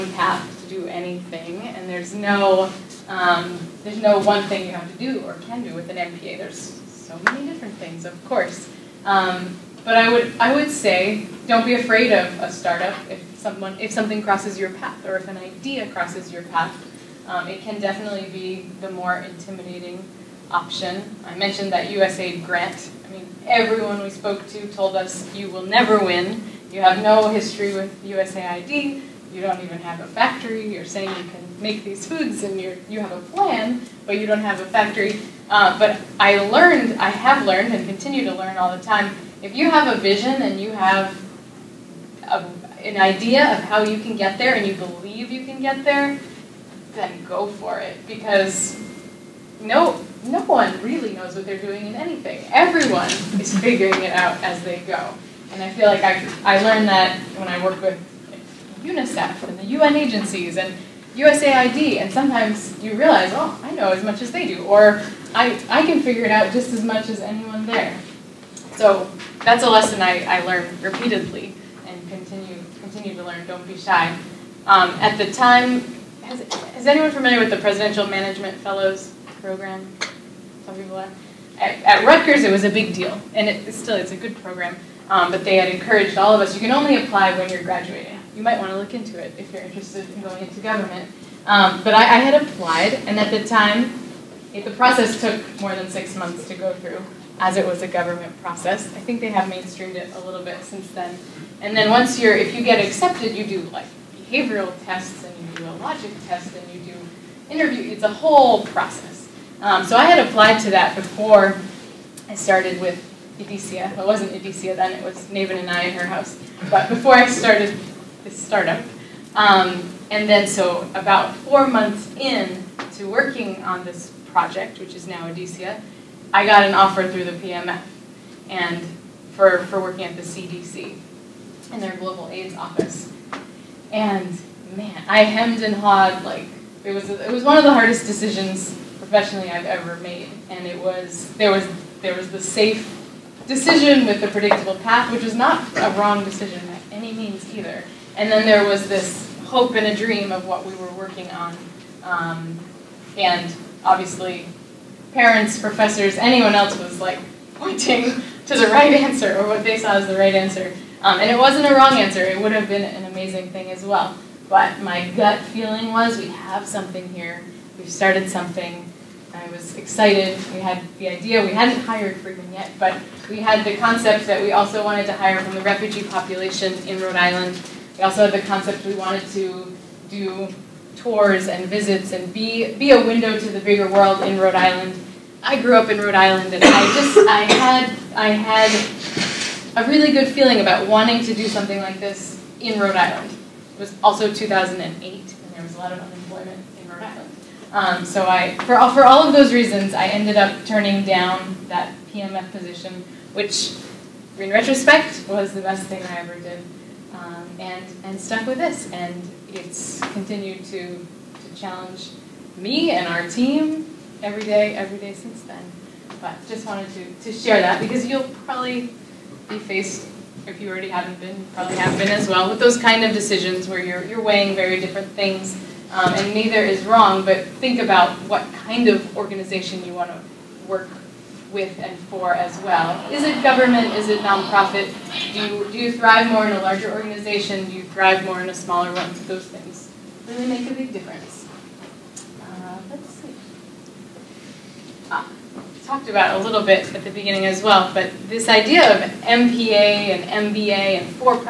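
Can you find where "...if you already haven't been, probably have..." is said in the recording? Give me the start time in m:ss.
3:40.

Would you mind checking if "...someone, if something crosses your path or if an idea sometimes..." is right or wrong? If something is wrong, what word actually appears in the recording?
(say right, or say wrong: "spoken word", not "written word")
wrong: "crosses", not "sometimes".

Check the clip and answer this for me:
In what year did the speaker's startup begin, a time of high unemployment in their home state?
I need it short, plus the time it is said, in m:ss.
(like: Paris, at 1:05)
2008, at 3:14.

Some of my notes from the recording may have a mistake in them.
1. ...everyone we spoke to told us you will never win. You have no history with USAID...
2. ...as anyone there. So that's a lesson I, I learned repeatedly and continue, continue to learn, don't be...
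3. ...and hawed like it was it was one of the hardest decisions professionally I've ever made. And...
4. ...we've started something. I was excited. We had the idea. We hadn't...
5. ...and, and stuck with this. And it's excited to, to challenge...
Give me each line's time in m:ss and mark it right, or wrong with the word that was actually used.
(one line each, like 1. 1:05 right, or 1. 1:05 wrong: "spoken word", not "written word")
1. 0:23 right
2. 1:07 right
3. 2:15 right
4. 2:47 right
5. 3:27 wrong: "continued", not "excited".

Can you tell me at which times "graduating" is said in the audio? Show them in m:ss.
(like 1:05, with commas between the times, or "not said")
1:27.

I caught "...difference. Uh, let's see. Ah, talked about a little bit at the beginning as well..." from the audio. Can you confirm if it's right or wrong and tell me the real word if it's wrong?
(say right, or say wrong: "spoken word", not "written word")
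right.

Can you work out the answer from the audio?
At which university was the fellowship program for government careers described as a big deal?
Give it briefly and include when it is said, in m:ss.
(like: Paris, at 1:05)
Rutgers, at 1:22.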